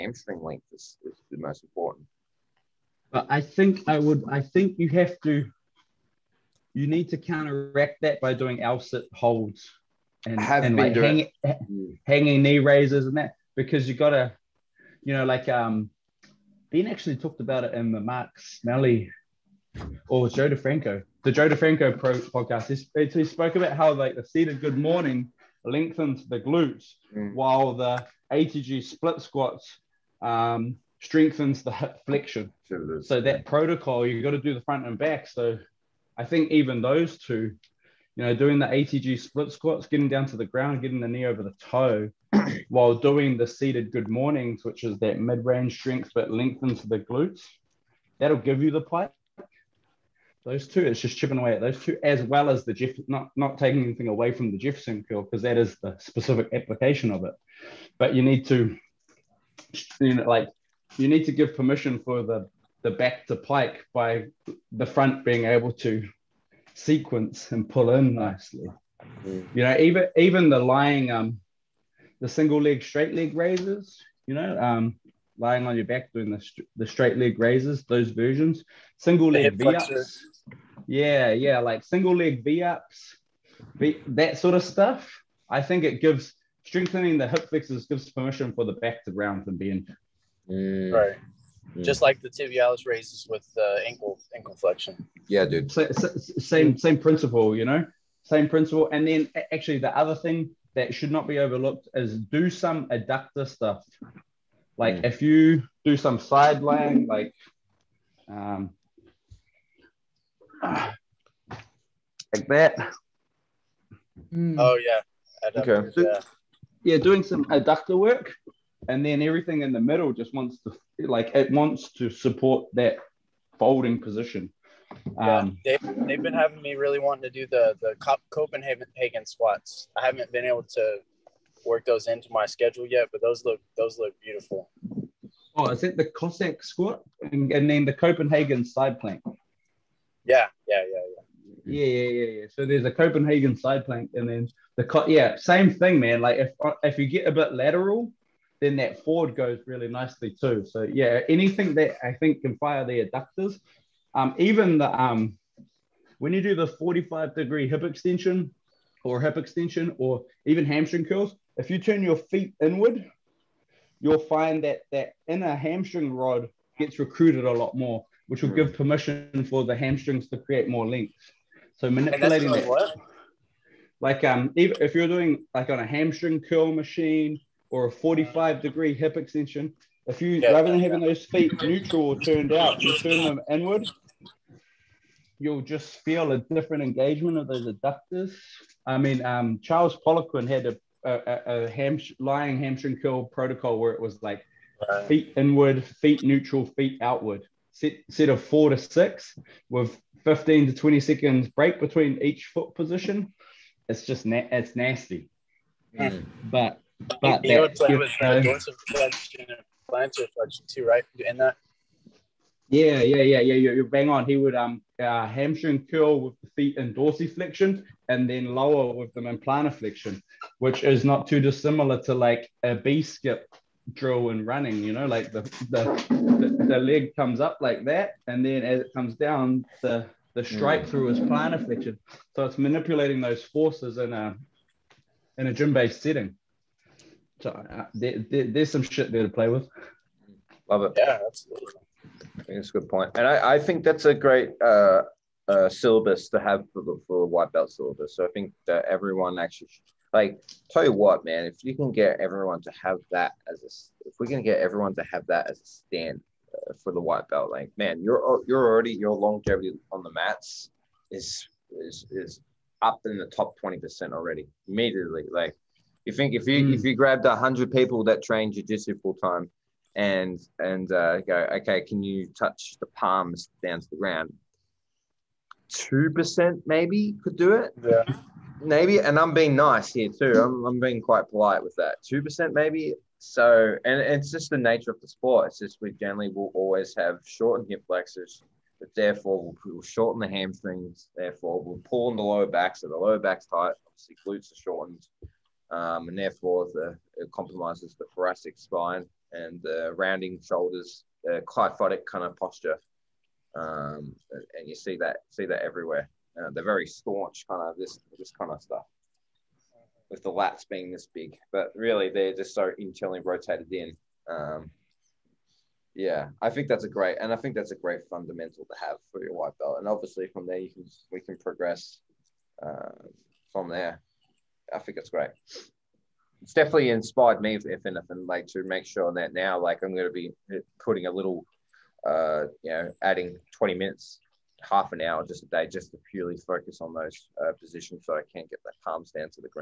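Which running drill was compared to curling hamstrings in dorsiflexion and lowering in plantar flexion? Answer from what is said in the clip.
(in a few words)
B skip drill.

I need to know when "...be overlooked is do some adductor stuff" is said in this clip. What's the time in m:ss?
1:41.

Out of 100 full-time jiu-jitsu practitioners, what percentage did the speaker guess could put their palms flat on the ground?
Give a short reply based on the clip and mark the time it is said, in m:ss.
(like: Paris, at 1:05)
2%, at 4:35.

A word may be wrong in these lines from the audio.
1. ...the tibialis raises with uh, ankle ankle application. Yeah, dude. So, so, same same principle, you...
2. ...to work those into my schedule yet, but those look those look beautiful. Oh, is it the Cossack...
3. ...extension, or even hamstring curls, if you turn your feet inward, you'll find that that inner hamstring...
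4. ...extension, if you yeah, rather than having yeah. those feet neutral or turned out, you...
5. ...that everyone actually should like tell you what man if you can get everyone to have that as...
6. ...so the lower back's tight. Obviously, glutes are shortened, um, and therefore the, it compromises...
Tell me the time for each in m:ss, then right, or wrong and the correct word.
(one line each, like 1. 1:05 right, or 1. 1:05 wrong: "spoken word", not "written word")
1. 1:32 wrong: "flexion", not "application"
2. 2:10 right
3. 2:39 right
4. 2:59 right
5. 4:08 right
6. 4:52 right.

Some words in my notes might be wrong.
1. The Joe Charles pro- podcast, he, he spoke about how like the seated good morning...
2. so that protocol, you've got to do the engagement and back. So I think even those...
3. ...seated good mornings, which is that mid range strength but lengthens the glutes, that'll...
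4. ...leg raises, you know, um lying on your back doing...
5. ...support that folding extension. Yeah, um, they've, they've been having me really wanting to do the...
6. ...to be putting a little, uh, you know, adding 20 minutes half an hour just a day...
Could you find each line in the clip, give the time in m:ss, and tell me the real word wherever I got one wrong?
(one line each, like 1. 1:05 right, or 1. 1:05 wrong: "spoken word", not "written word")
1. 0:21 wrong: "DeFranco", not "Charles"
2. 0:33 wrong: "front", not "engagement"
3. 0:43 right
4. 1:13 right
5. 2:02 wrong: "position", not "extension"
6. 5:30 right.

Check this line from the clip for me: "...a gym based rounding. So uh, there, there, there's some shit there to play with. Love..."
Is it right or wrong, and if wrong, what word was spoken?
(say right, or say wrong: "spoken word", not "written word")
wrong: "setting", not "rounding".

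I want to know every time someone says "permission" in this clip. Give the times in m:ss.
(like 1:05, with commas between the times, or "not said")
1:01, 1:28, 2:48.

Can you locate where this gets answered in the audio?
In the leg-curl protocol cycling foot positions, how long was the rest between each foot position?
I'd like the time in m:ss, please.
3:20.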